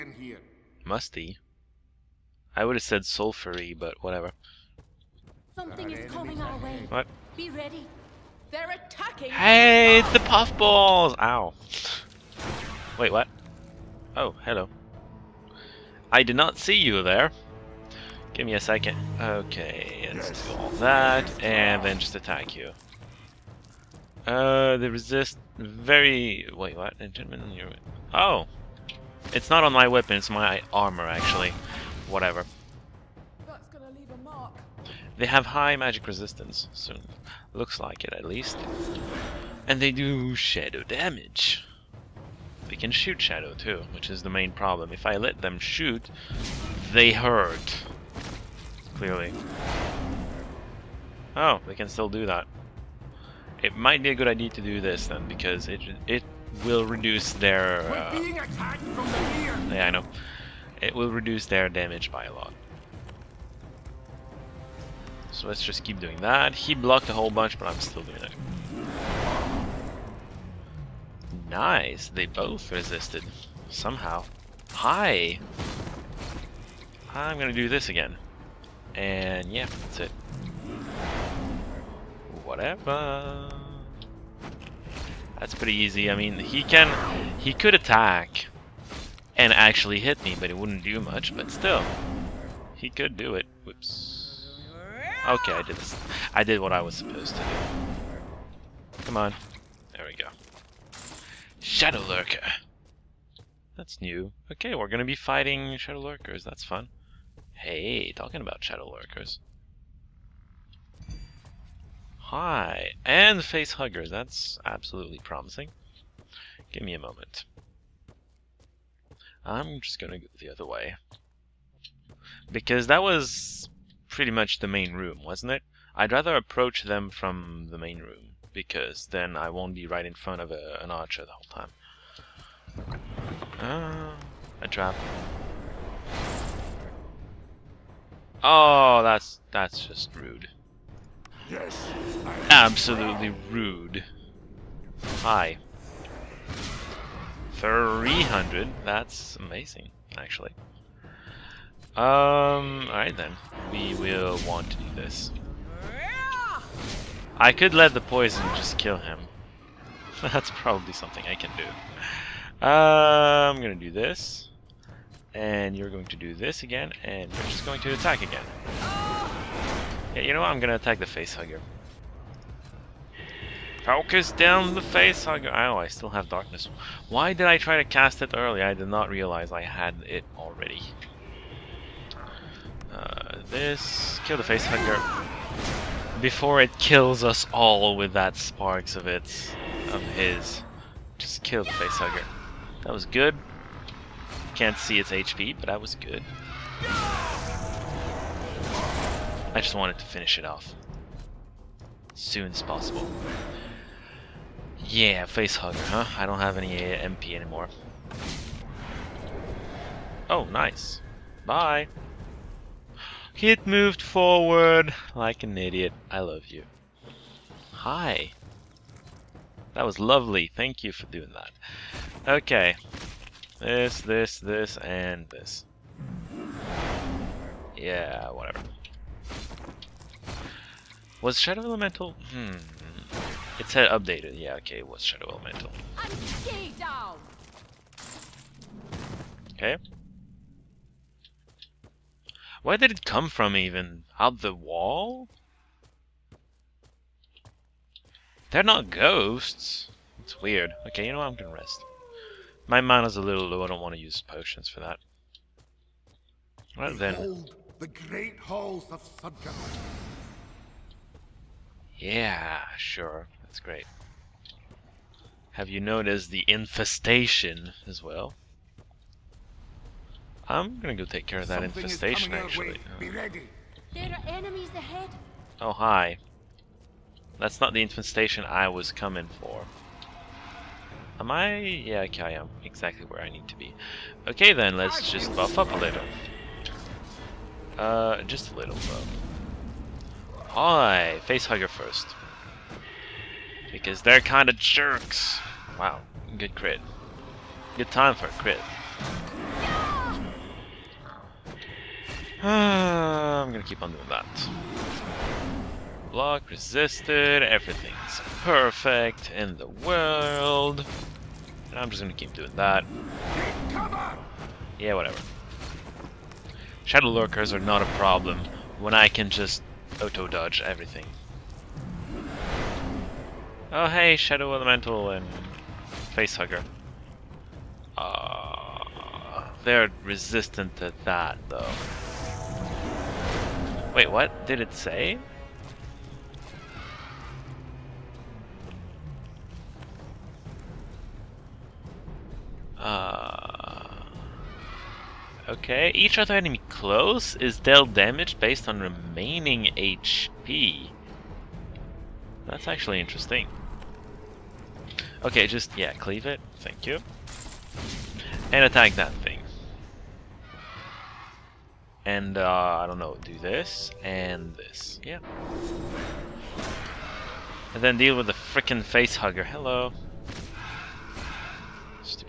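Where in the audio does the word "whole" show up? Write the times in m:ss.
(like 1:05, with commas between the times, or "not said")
1:07, 2:11.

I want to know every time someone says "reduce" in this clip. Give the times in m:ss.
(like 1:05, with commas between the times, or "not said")
0:56, 1:01.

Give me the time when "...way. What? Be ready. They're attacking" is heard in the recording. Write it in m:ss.
0:06.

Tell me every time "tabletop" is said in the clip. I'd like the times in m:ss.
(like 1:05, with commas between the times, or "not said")
not said.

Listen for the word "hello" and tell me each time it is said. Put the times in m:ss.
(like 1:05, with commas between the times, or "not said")
0:14, 6:09.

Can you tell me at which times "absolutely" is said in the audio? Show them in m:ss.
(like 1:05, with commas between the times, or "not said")
1:54, 2:22.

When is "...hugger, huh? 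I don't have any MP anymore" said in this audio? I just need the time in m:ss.
3:25.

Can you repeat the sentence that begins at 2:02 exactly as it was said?
Because that was pretty much the main room, wasn't it?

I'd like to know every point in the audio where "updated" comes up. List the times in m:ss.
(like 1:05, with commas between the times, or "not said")
3:53.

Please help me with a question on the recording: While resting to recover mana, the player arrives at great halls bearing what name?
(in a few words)
Sudgerd.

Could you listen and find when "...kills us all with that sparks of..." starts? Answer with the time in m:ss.
3:06.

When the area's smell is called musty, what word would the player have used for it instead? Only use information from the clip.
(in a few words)
sulfury.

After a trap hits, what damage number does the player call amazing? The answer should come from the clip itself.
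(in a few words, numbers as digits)
300.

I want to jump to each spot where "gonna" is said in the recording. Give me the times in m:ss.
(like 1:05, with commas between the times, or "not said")
1:17, 1:44, 2:43, 2:50, 4:11, 4:30, 5:03, 5:12.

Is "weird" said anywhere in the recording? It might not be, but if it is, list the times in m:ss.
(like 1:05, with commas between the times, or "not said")
4:10.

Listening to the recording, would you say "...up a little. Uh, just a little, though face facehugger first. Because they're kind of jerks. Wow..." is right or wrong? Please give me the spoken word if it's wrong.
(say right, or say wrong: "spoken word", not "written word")
right.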